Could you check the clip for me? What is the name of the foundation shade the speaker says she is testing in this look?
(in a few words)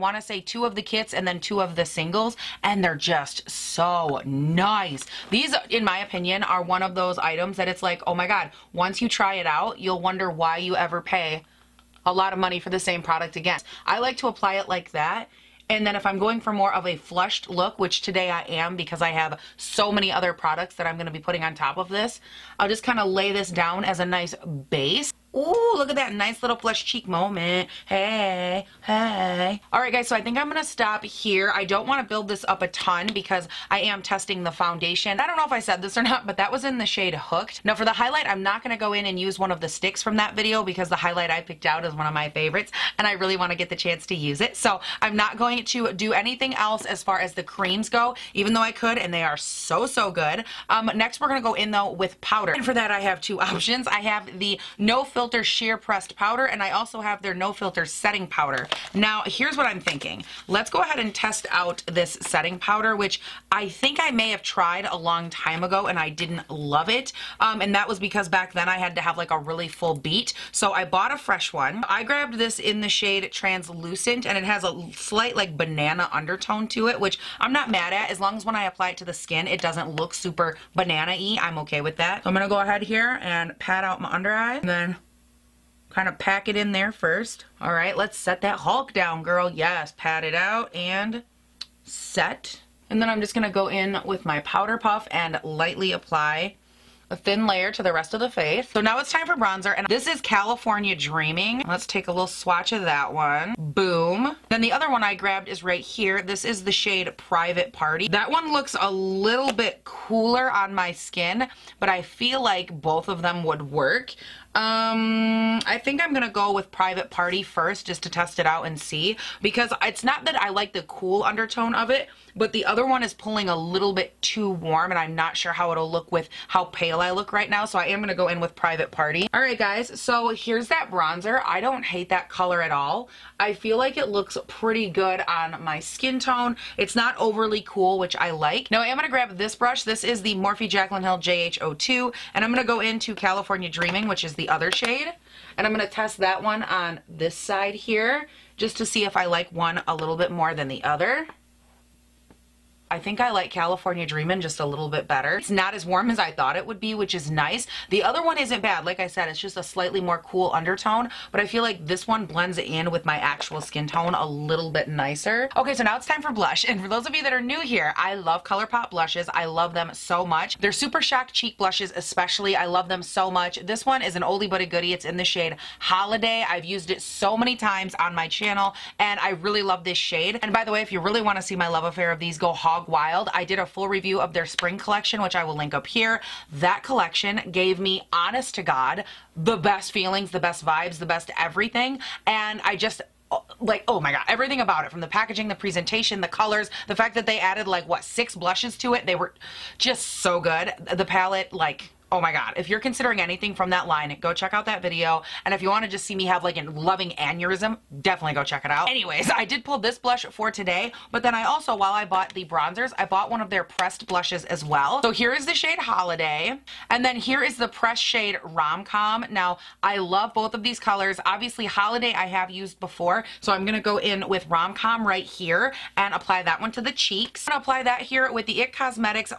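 Hooked.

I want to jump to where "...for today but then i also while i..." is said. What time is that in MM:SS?
03:30.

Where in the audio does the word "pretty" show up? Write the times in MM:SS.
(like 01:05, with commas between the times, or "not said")
02:14.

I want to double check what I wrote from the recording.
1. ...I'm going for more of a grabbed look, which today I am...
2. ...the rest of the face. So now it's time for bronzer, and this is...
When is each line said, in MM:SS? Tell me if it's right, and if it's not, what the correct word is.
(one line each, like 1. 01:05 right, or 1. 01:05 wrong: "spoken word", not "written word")
1. 00:16 wrong: "flushed", not "grabbed"
2. 01:37 right.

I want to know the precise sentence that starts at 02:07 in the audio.
So I am gonna go in with Private Party.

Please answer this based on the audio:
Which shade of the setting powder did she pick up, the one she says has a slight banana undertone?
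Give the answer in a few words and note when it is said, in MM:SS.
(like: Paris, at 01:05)
Translucent, at 01:13.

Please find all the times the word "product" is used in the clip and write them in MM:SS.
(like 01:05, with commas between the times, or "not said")
00:13, 00:20.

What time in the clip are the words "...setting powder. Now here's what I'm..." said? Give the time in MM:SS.
00:57.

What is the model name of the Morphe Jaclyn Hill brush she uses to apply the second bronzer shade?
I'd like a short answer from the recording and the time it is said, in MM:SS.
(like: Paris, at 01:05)
JH02, at 02:21.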